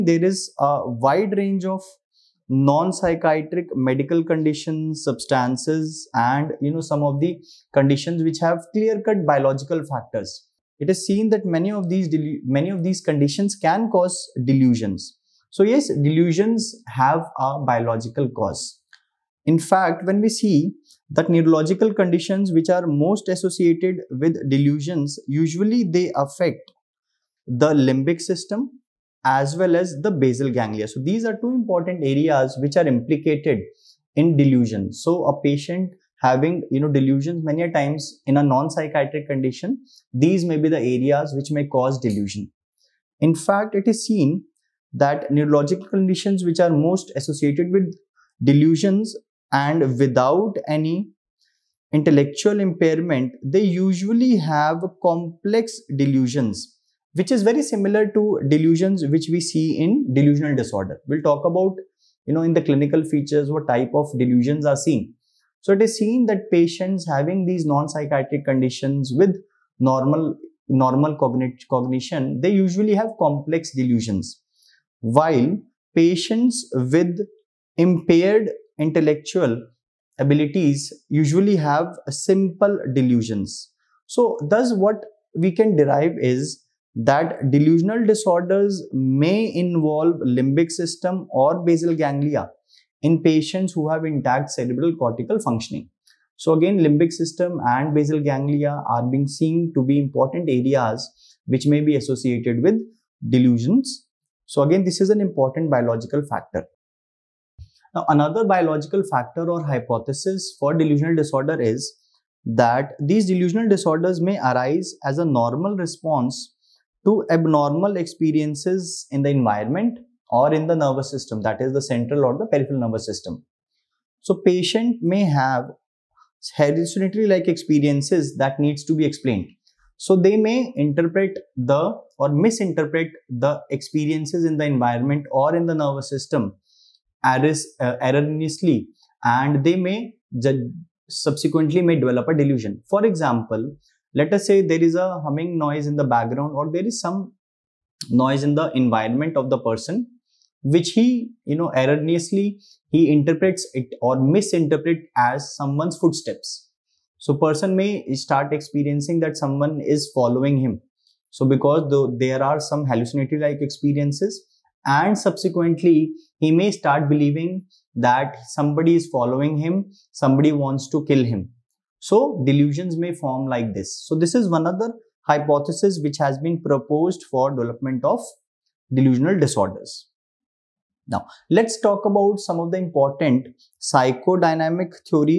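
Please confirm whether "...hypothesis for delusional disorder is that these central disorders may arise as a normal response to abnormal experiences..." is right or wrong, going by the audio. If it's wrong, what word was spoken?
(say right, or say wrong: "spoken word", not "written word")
wrong: "delusional", not "central".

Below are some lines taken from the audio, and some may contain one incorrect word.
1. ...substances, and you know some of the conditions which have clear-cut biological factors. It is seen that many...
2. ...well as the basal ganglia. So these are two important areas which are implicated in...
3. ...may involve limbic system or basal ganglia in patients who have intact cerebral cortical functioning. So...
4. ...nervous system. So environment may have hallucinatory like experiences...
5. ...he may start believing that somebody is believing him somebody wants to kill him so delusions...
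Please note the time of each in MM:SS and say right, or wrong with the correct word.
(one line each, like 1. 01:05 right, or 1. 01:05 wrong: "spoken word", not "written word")
1. 00:05 right
2. 00:29 right
3. 01:28 right
4. 02:02 wrong: "patient", not "environment"
5. 02:46 wrong: "following", not "believing".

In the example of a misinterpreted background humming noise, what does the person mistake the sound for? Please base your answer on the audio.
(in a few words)
Footsteps.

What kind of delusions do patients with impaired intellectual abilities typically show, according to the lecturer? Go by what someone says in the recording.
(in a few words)
Simple delusions.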